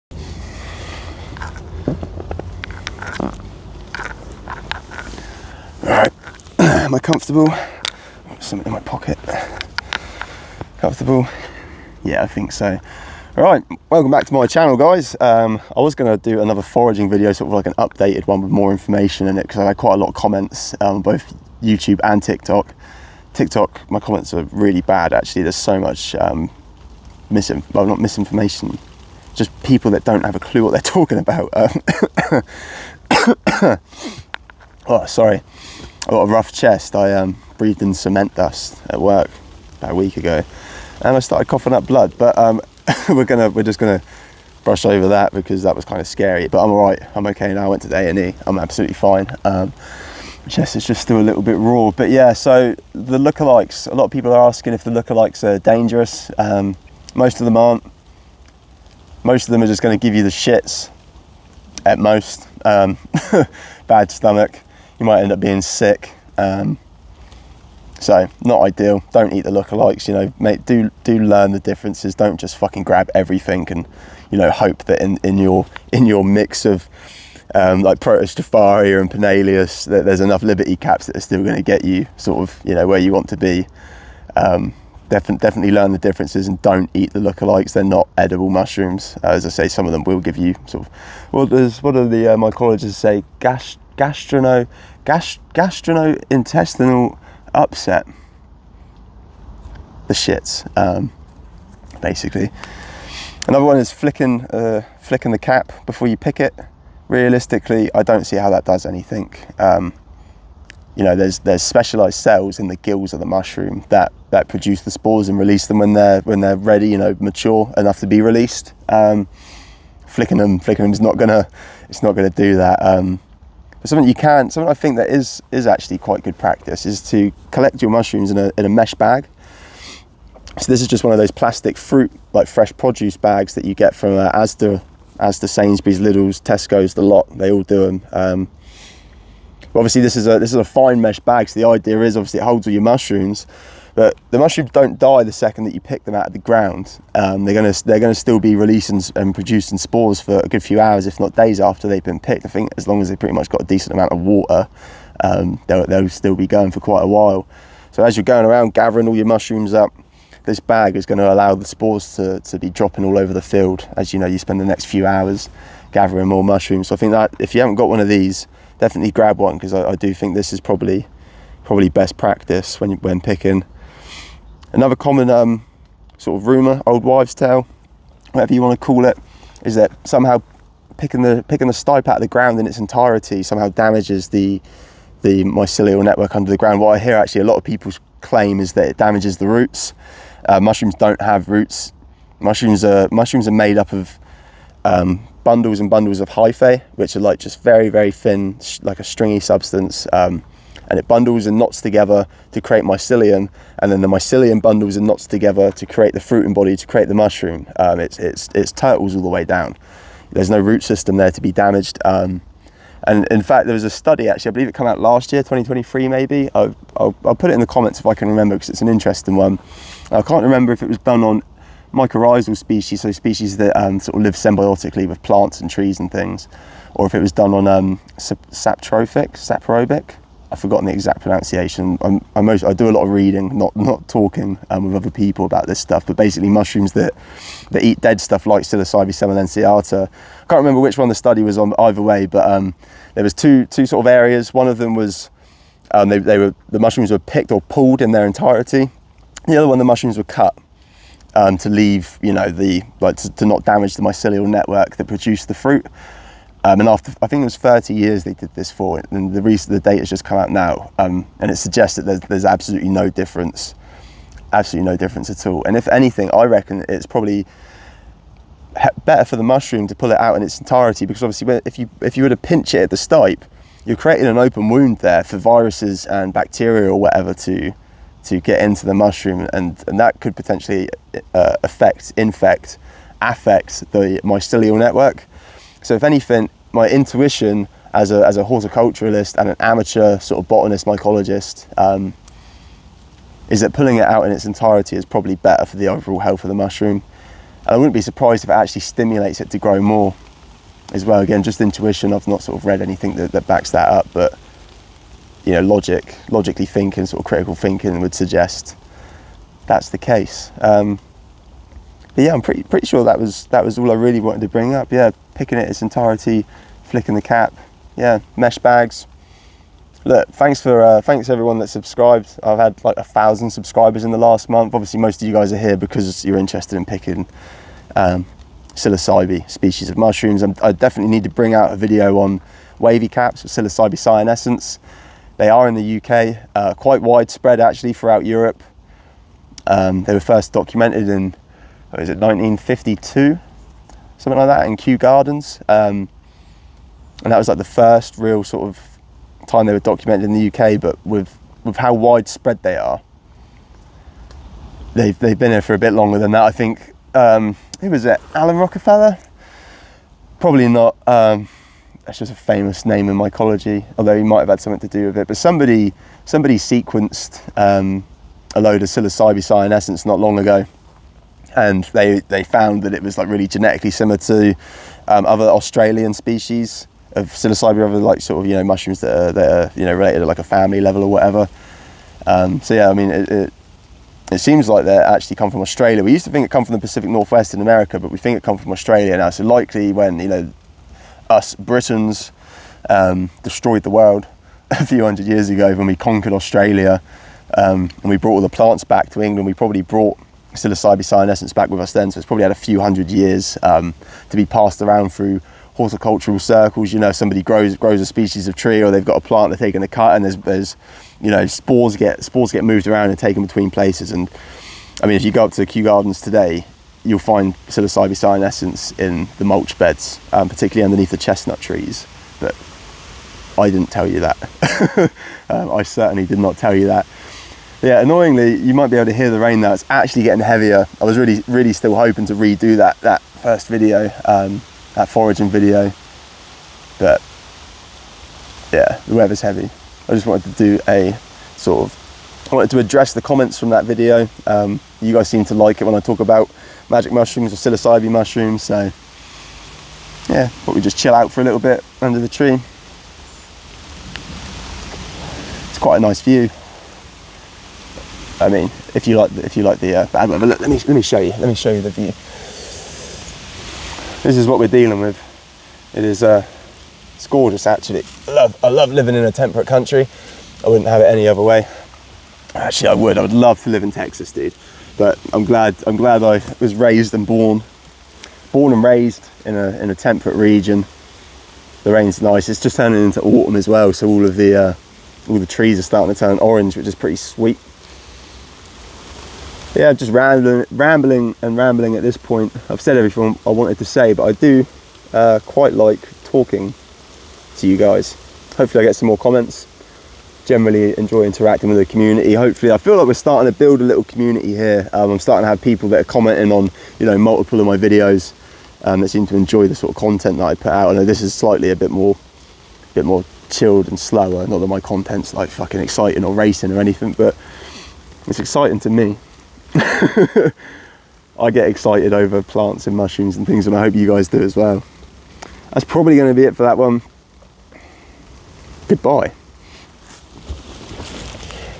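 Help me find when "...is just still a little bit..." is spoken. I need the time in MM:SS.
00:50.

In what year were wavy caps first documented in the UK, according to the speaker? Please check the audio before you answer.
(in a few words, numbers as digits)
1952.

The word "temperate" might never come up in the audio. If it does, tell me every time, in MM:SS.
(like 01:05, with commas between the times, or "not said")
07:49, 07:59.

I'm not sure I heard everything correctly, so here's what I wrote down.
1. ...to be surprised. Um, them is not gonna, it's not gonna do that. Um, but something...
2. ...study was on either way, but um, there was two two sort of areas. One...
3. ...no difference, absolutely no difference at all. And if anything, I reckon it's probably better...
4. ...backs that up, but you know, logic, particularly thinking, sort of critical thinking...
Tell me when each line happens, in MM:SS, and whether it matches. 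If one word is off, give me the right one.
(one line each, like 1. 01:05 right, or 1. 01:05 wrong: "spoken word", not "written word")
1. 01:57 wrong: "released", not "surprised"
2. 04:01 right
3. 04:22 right
4. 05:03 wrong: "logically", not "particularly".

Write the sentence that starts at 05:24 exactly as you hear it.
Obviously, most of you guys are here because you're interested in picking um, psilocybe species of mushrooms.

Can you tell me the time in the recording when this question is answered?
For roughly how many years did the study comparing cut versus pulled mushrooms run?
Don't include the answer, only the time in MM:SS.
04:17.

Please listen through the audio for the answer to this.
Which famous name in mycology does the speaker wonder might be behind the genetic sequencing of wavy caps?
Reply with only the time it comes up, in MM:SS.
05:58.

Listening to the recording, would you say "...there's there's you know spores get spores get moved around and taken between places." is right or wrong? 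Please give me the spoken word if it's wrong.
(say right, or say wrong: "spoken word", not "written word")
right.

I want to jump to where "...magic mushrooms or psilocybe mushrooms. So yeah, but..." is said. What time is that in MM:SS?
07:26.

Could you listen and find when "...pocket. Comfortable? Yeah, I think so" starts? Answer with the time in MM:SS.
00:08.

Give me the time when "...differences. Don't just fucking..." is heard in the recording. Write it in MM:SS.
01:11.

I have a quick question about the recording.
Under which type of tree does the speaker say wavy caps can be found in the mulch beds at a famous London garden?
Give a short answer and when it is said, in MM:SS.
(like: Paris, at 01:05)
chestnut trees, at 07:01.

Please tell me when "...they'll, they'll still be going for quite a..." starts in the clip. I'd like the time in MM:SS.
02:35.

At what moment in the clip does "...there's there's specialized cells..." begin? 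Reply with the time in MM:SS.
01:51.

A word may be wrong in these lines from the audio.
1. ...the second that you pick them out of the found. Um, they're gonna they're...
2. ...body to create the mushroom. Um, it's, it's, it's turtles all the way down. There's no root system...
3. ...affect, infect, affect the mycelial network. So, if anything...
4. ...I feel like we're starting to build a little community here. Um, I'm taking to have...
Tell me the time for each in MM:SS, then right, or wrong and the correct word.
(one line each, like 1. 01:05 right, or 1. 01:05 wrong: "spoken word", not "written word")
1. 02:25 wrong: "ground", not "found"
2. 03:26 right
3. 04:41 right
4. 08:22 wrong: "starting", not "taking".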